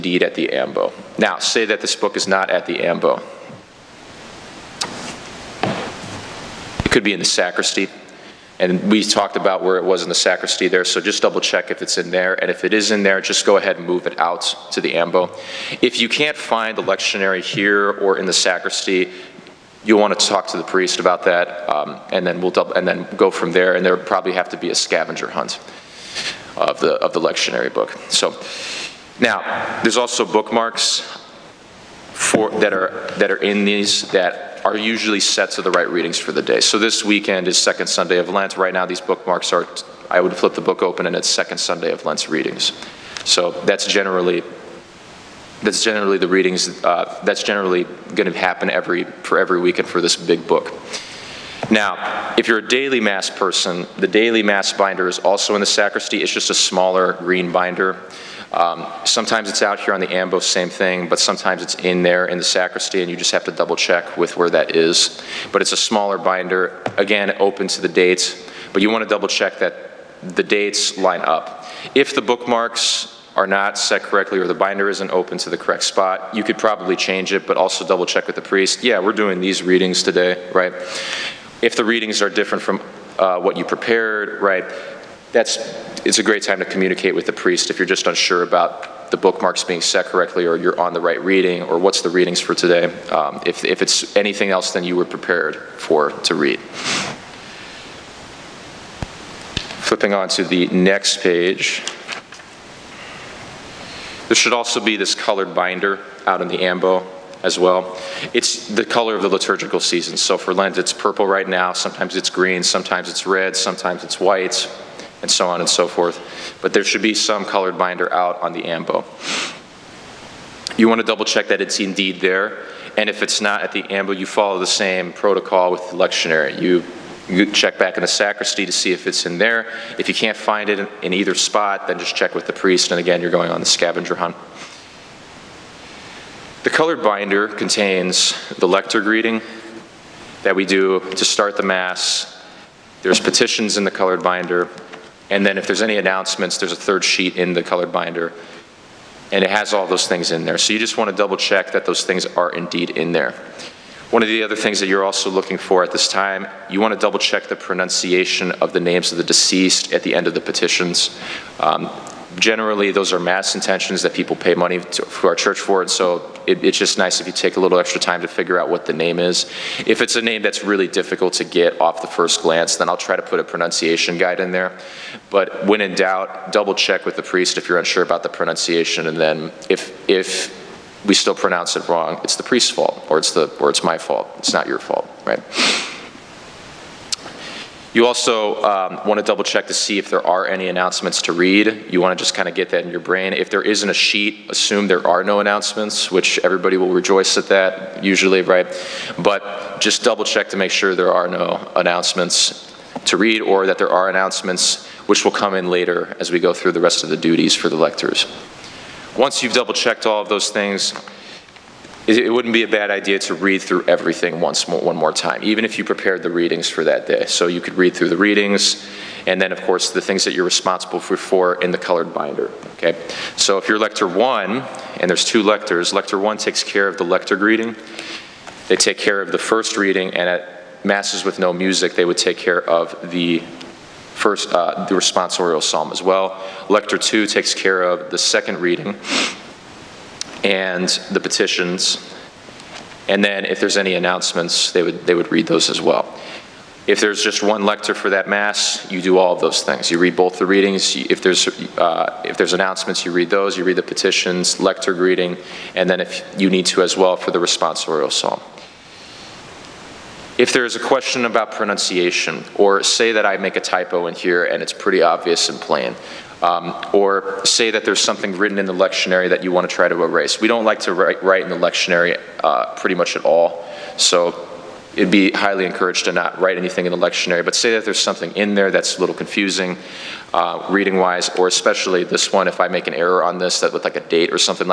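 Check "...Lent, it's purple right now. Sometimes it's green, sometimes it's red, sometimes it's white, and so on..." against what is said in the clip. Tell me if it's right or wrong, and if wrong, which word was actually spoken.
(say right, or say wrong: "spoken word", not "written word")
right.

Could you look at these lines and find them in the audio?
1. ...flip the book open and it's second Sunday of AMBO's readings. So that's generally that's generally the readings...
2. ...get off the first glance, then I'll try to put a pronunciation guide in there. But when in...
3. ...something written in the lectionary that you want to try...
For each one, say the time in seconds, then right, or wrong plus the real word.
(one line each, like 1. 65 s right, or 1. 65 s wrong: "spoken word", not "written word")
1. 40 s wrong: "Lent", not "AMBO"
2. 171 s right
3. 267 s right.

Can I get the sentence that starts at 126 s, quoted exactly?
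You, you check back in the sacristy to see if it's in there.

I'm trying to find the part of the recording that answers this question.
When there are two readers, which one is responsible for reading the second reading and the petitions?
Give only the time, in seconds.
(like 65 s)
236 s.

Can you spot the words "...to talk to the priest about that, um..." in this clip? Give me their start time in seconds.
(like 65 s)
20 s.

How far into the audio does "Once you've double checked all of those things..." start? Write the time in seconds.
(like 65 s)
209 s.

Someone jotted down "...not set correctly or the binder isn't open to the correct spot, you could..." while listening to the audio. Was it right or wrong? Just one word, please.
right.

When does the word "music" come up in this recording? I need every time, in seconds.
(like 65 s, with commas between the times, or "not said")
231 s.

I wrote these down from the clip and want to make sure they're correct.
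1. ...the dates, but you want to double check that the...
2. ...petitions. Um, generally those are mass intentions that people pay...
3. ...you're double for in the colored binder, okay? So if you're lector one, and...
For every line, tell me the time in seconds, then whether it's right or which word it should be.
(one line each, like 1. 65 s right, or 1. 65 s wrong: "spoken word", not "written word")
1. 67 s right
2. 160 s right
3. 220 s wrong: "responsible", not "double".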